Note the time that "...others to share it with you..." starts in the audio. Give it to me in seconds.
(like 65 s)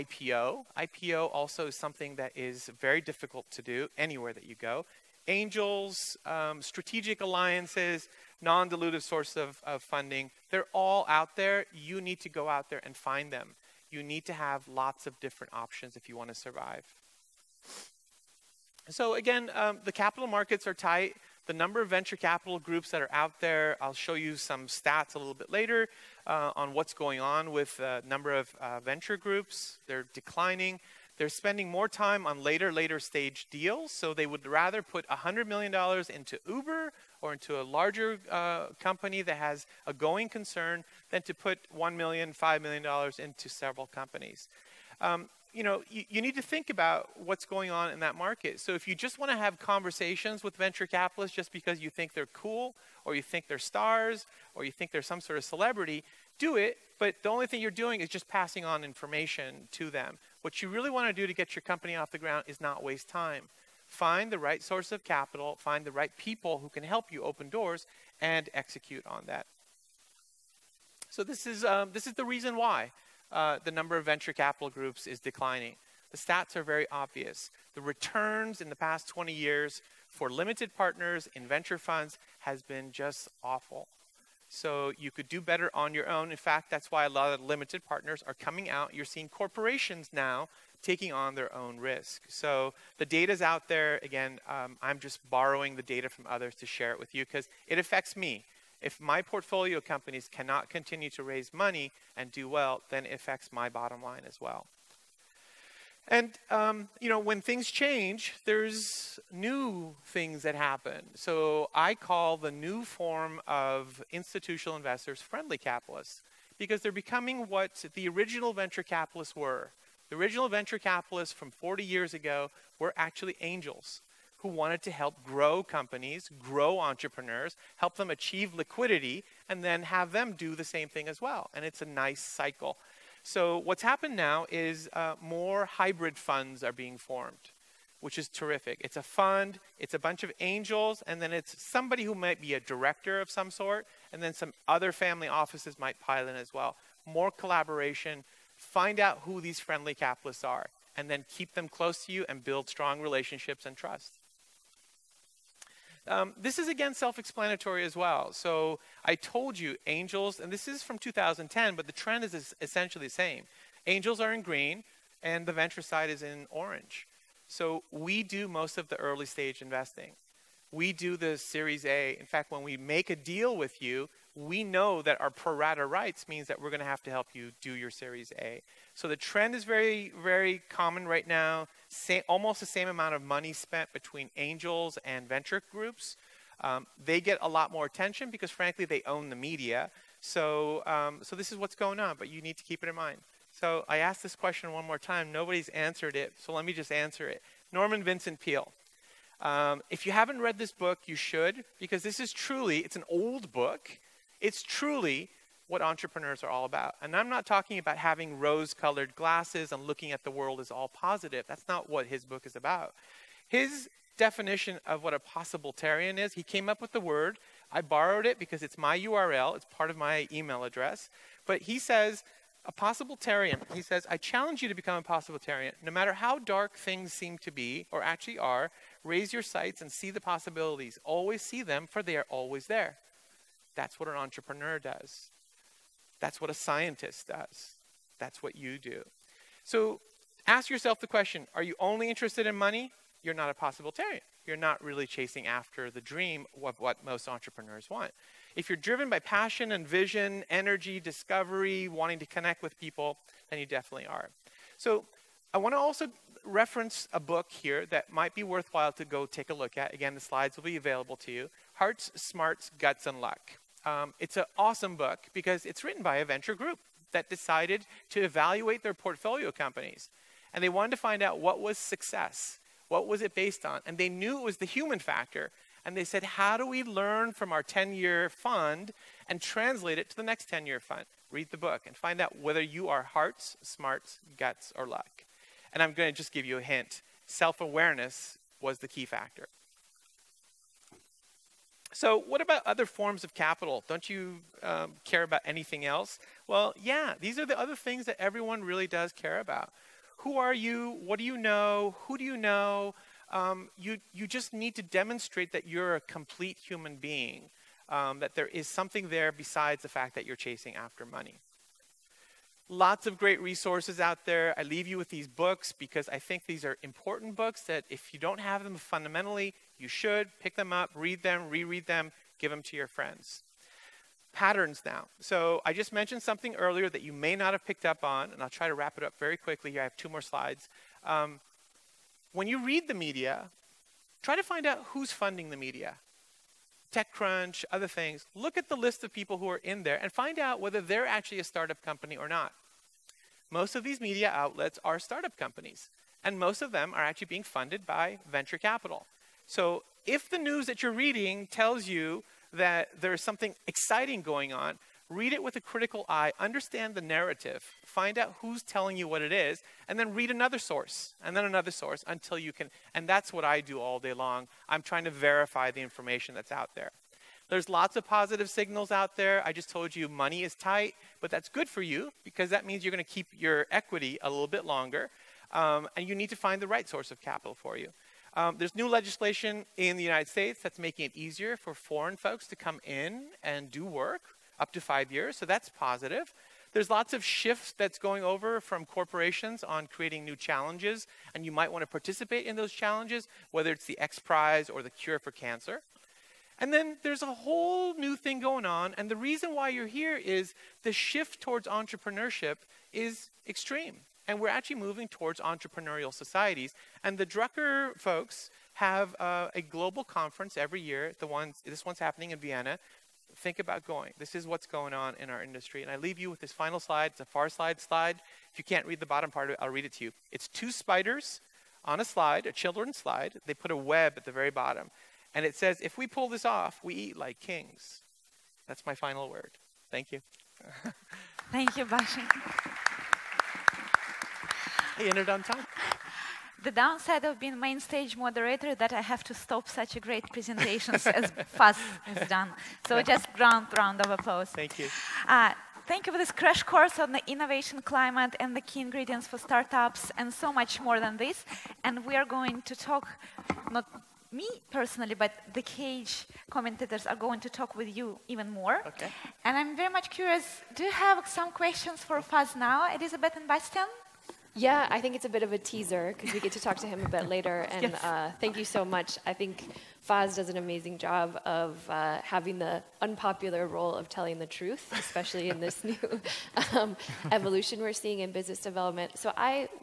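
96 s.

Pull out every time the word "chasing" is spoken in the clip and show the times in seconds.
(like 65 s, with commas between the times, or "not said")
245 s, 310 s.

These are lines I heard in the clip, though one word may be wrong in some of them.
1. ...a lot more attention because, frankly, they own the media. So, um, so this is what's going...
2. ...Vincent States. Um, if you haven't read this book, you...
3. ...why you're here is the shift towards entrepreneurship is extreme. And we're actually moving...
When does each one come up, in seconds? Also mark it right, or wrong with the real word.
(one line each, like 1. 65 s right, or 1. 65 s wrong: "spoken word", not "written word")
1. 187 s right
2. 198 s wrong: "Peale", not "States"
3. 399 s right.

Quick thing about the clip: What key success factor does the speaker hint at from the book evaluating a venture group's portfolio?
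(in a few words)
self awareness.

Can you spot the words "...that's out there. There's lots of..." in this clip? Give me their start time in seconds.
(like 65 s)
366 s.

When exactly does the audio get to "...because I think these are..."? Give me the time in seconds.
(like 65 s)
315 s.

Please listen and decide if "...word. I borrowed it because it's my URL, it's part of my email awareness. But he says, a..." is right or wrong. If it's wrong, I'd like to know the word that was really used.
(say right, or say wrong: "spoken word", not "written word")
wrong: "address", not "awareness".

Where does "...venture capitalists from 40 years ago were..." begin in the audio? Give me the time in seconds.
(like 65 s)
120 s.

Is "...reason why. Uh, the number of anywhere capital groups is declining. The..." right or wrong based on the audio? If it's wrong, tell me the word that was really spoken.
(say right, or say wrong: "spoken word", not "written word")
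wrong: "venture", not "anywhere".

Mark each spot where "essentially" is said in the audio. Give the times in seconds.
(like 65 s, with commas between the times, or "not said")
162 s.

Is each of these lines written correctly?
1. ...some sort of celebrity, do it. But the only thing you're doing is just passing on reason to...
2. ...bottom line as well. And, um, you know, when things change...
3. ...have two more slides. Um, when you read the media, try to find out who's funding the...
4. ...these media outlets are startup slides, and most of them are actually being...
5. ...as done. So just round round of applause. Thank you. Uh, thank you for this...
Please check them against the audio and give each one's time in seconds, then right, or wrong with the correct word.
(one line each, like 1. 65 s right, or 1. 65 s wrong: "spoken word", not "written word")
1. 55 s wrong: "information", not "reason"
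2. 103 s right
3. 329 s right
4. 343 s wrong: "companies", not "slides"
5. 442 s right.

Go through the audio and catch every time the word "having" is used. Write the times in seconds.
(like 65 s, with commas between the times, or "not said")
207 s, 472 s.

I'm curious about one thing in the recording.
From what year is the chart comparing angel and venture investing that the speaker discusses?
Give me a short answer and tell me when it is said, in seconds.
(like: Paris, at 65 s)
2010, at 160 s.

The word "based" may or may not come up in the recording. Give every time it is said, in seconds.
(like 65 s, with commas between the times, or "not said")
273 s.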